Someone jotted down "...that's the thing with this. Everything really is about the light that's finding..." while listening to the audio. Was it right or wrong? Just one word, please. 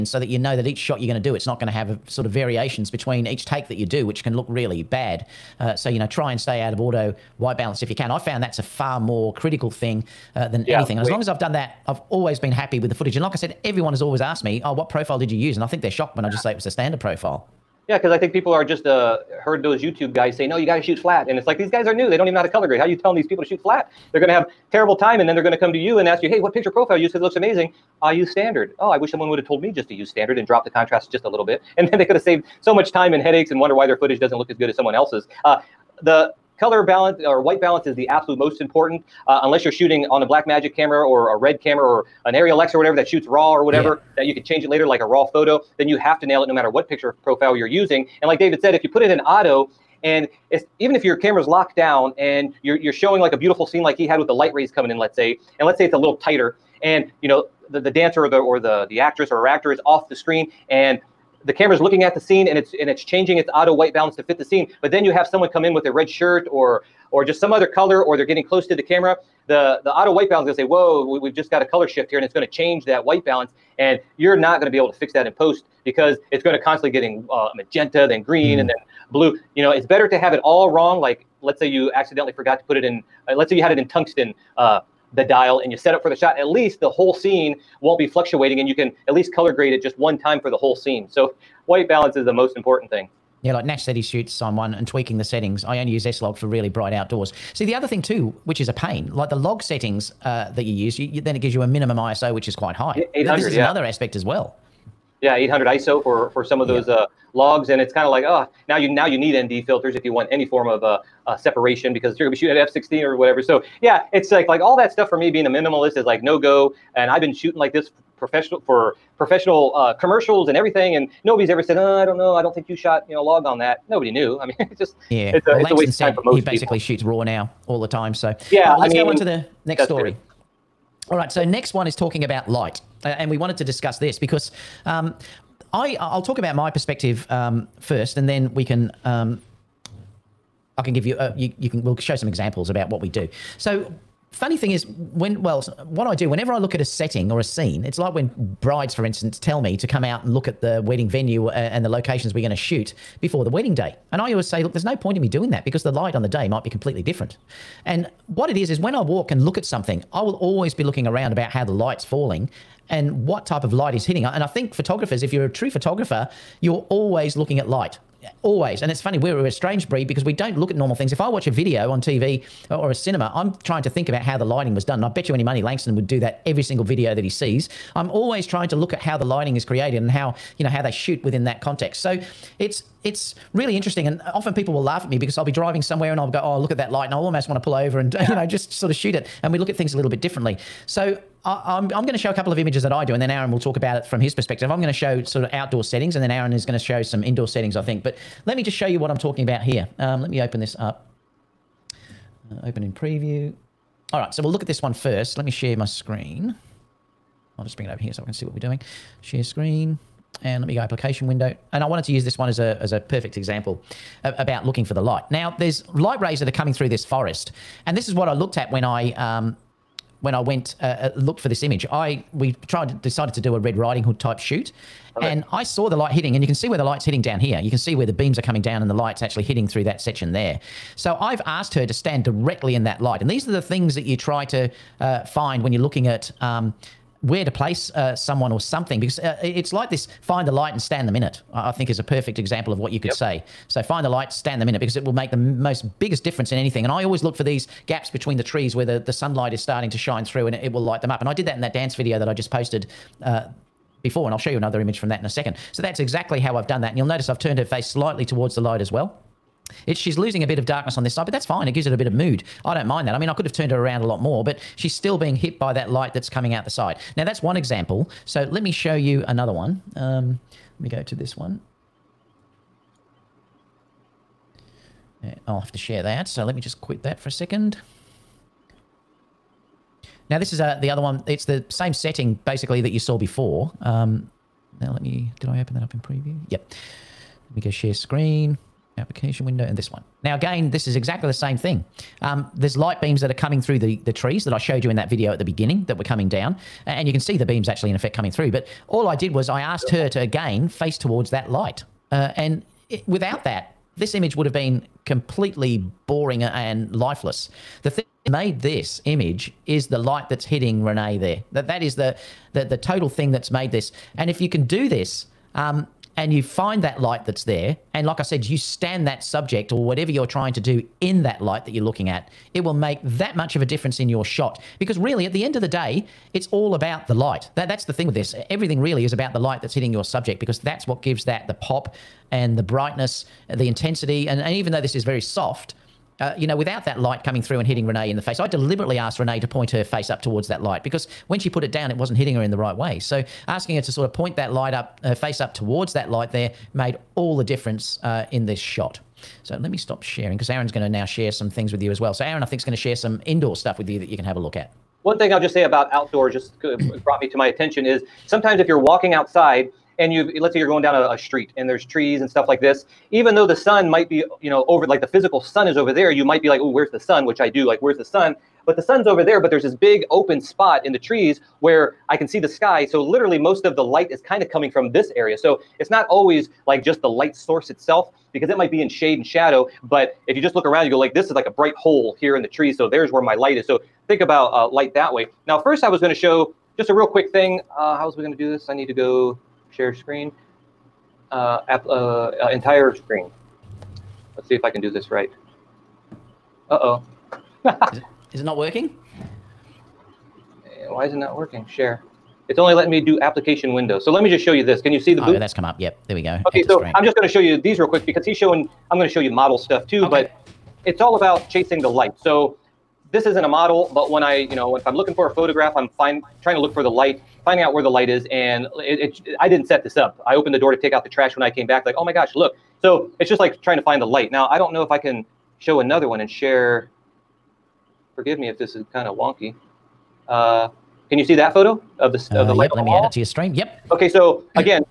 wrong.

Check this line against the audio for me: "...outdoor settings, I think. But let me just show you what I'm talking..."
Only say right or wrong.
wrong.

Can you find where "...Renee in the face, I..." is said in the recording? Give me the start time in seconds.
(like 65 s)
337 s.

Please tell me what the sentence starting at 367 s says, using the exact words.
Which I do like, where's the sun?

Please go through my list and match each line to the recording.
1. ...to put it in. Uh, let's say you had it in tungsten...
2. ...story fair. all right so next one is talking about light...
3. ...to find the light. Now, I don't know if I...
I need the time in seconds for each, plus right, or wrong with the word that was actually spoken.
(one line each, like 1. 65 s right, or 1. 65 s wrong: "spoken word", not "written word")
1. 82 s right
2. 129 s right
3. 423 s right.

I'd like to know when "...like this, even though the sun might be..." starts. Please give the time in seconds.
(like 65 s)
362 s.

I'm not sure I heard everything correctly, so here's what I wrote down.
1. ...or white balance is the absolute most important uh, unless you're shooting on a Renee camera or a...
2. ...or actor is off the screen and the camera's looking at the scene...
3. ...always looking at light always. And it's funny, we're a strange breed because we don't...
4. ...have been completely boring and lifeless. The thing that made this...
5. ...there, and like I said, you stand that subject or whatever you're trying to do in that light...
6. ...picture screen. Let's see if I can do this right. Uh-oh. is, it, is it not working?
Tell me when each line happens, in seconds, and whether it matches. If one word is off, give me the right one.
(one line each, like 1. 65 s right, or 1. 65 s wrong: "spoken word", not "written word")
1. 37 s wrong: "Blackmagic", not "Renee"
2. 59 s right
3. 166 s right
4. 304 s right
5. 317 s right
6. 392 s wrong: "entire", not "picture".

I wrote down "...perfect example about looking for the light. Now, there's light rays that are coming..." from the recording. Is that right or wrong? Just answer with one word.
right.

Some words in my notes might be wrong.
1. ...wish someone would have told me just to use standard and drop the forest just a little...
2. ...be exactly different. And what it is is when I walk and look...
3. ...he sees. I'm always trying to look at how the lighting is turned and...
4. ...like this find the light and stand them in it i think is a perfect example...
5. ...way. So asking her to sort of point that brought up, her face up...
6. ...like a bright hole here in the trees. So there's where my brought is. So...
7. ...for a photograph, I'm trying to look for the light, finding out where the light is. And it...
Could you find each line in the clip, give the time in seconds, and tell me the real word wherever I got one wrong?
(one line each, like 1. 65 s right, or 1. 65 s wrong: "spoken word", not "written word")
1. 28 s wrong: "contrast", not "forest"
2. 156 s wrong: "completely", not "exactly"
3. 177 s wrong: "created", not "turned"
4. 239 s right
5. 342 s wrong: "light", not "brought"
6. 381 s wrong: "light", not "brought"
7. 415 s right.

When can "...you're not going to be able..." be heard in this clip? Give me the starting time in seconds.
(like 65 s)
74 s.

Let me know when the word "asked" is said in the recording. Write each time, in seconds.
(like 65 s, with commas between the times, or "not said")
14 s, 231 s, 299 s, 338 s.